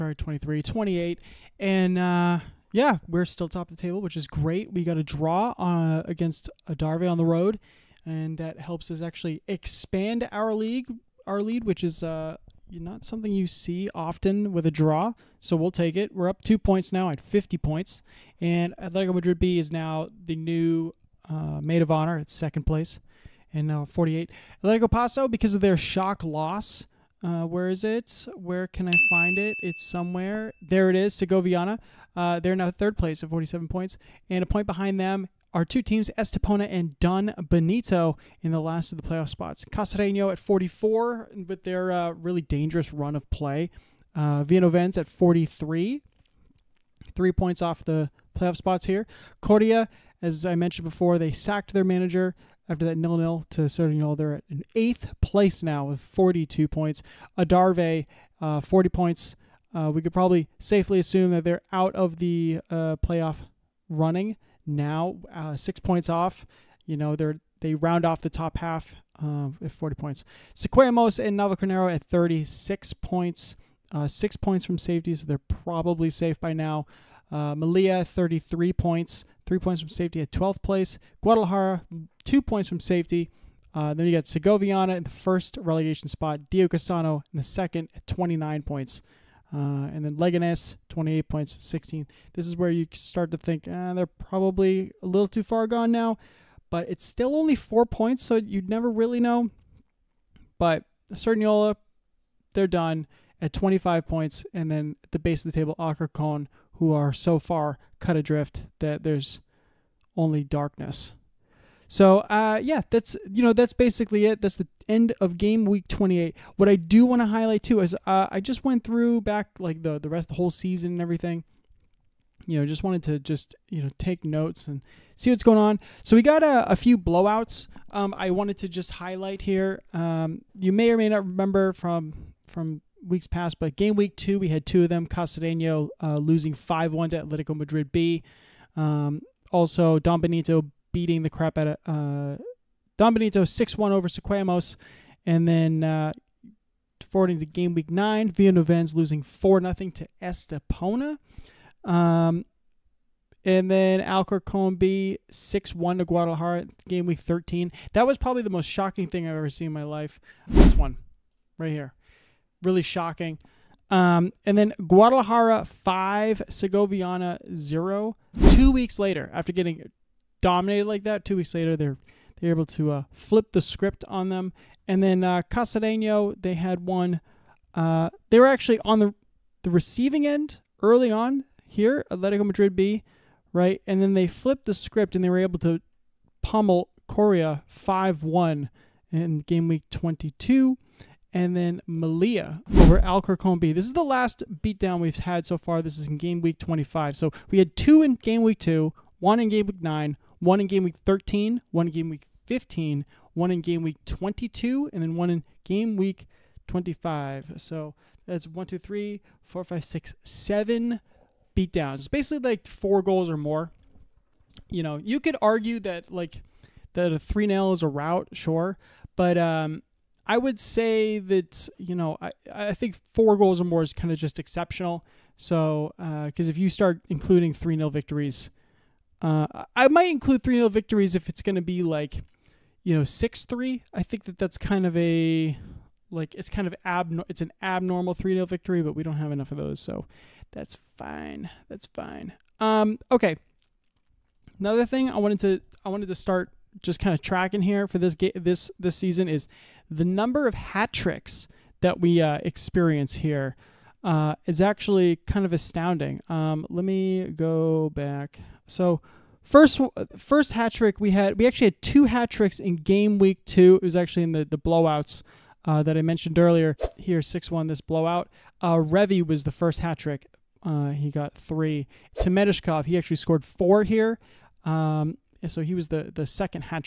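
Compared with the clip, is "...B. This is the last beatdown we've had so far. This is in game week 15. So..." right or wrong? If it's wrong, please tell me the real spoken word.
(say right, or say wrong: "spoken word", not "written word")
wrong: "25", not "15".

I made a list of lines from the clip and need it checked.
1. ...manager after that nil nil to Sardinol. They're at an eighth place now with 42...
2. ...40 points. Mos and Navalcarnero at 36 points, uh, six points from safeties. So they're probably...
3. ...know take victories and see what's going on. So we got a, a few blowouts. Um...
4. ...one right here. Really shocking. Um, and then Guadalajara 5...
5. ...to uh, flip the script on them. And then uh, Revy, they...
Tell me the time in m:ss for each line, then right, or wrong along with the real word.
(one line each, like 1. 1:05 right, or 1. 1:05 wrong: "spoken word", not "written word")
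1. 0:51 right
2. 1:09 right
3. 2:03 wrong: "notes", not "victories"
4. 2:40 right
5. 2:52 wrong: "Casadeno", not "Revy".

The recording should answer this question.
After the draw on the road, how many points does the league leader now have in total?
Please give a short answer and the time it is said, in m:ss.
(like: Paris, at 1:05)
50, at 0:17.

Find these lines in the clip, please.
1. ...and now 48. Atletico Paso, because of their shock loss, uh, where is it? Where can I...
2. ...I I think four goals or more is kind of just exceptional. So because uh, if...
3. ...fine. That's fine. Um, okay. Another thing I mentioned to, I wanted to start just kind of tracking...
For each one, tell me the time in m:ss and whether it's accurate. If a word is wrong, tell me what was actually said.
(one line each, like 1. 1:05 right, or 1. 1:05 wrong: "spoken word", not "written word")
1. 0:23 right
2. 3:42 right
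3. 4:00 wrong: "wanted", not "mentioned".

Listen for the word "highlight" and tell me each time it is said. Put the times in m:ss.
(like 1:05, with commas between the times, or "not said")
1:57, 2:08.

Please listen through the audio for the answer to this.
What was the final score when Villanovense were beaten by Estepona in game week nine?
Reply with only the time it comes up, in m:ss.
2:29.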